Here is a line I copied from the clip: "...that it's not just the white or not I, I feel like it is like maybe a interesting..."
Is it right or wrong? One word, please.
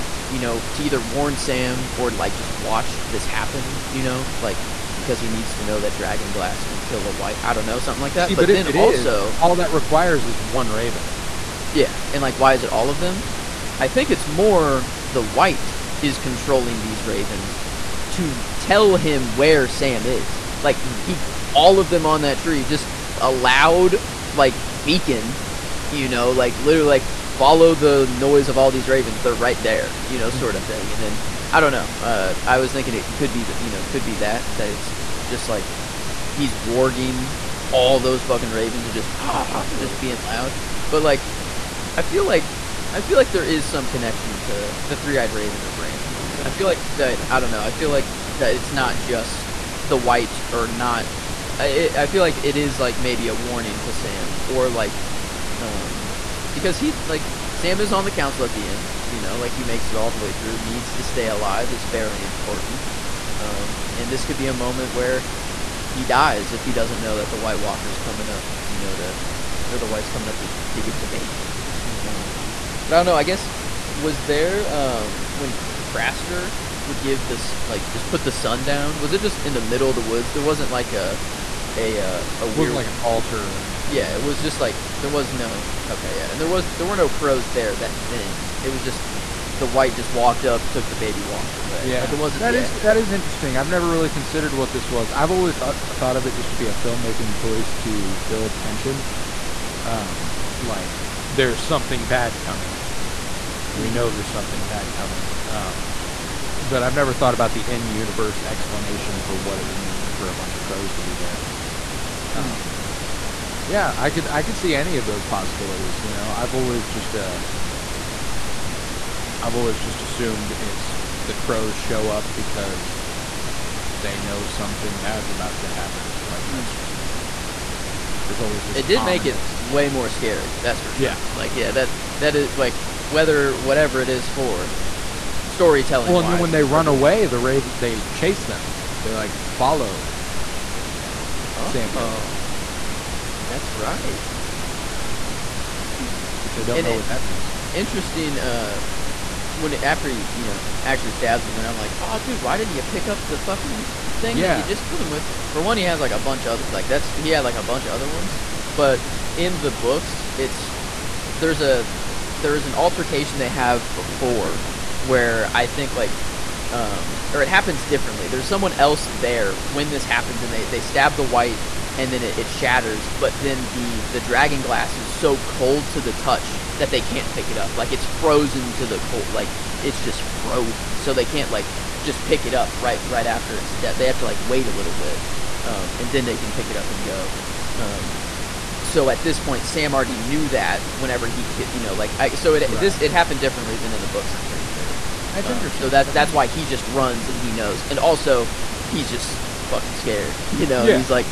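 wrong.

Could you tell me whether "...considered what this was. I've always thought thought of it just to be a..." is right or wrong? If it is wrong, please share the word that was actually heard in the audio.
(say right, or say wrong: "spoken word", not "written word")
right.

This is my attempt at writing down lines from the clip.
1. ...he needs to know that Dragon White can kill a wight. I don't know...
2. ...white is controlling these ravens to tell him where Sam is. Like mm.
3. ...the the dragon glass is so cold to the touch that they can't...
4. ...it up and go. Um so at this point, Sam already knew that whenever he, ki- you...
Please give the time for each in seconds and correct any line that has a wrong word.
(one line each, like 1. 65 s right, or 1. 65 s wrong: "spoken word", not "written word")
1. 5 s wrong: "Glass", not "White"
2. 15 s right
3. 173 s right
4. 186 s right.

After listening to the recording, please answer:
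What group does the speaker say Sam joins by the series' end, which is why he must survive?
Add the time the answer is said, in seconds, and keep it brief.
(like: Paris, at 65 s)
The council, at 58 s.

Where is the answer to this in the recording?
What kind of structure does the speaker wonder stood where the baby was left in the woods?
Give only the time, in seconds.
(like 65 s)
82 s.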